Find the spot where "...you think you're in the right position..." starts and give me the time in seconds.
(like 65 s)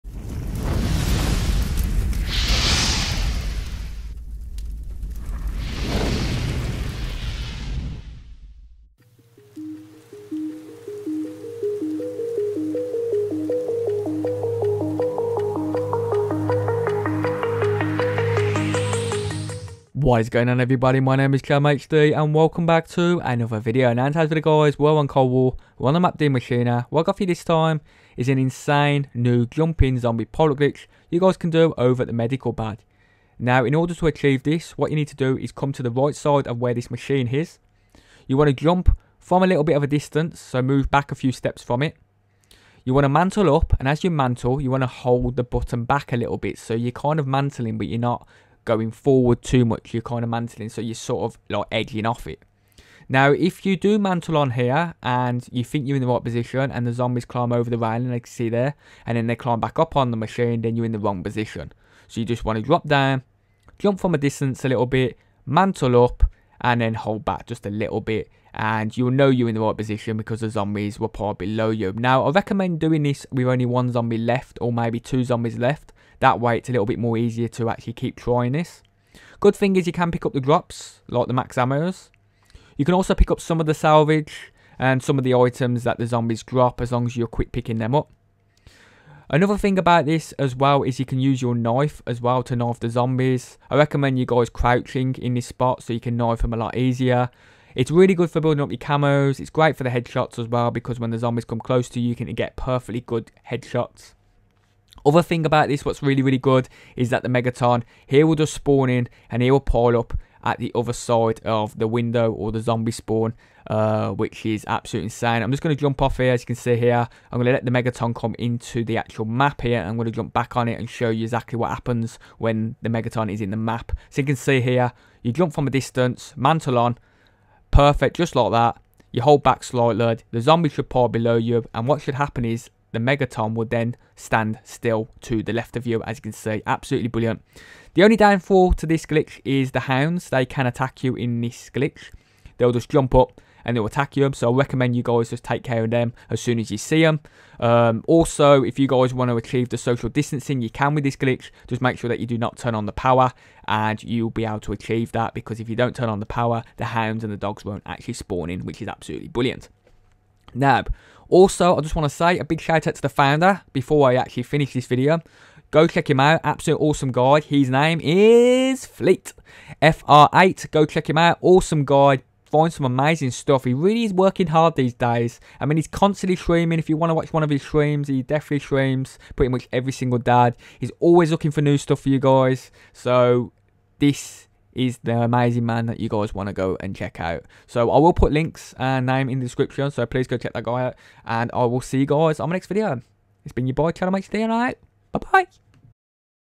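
55 s.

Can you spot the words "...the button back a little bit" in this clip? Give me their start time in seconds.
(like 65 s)
45 s.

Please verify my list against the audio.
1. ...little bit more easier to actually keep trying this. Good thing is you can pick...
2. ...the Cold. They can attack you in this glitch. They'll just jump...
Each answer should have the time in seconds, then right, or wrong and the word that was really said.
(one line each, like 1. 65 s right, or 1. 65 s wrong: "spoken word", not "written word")
1. 76 s right
2. 139 s wrong: "Hounds", not "Cold".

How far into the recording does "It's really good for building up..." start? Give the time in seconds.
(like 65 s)
97 s.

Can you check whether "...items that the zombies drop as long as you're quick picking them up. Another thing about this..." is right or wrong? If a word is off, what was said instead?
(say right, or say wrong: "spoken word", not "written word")
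right.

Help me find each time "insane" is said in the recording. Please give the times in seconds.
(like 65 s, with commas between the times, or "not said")
28 s, 115 s.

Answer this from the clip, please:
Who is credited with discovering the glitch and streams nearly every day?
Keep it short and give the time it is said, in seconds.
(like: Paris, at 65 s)
Fleet, at 168 s.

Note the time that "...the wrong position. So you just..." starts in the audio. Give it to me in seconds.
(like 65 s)
60 s.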